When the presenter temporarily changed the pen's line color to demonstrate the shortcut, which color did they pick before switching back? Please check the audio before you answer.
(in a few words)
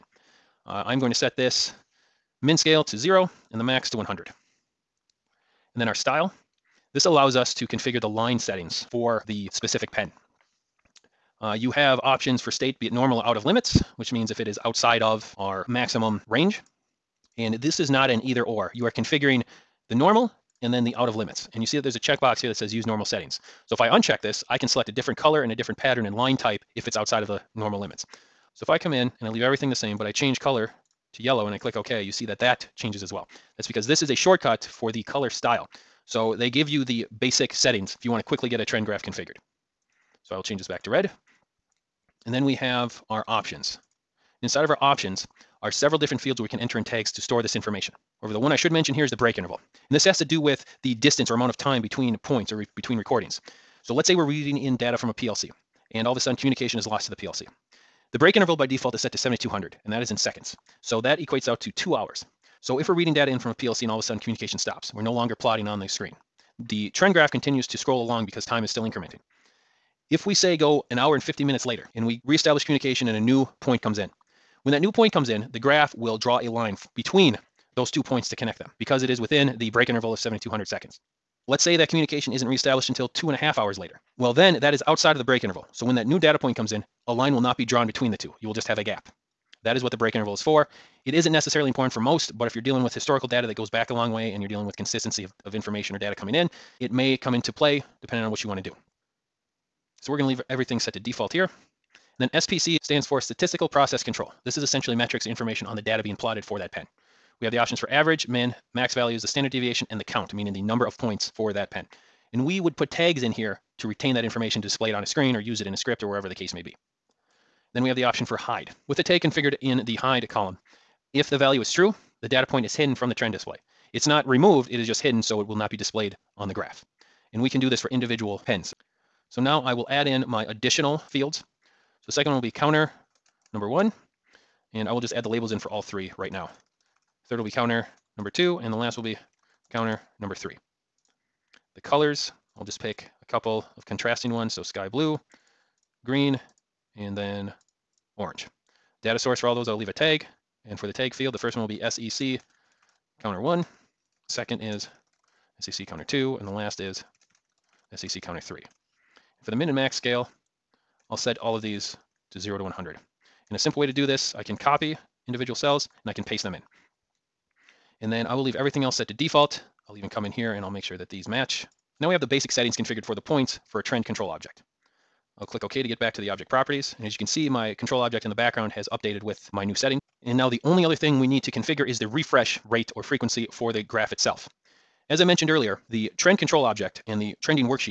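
yellow.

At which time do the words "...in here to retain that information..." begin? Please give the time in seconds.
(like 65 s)
113 s.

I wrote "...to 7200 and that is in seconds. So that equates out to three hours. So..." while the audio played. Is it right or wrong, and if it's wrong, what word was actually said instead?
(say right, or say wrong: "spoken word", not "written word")
wrong: "two", not "three".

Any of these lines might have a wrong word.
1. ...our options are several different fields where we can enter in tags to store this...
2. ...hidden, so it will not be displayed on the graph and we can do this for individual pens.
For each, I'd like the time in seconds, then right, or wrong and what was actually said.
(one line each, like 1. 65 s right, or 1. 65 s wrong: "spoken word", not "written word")
1. 44 s right
2. 124 s right.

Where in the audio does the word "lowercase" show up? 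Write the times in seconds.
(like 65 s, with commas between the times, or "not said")
not said.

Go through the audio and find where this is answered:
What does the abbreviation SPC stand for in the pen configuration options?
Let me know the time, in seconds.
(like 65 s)
103 s.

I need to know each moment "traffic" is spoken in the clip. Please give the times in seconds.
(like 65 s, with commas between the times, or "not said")
not said.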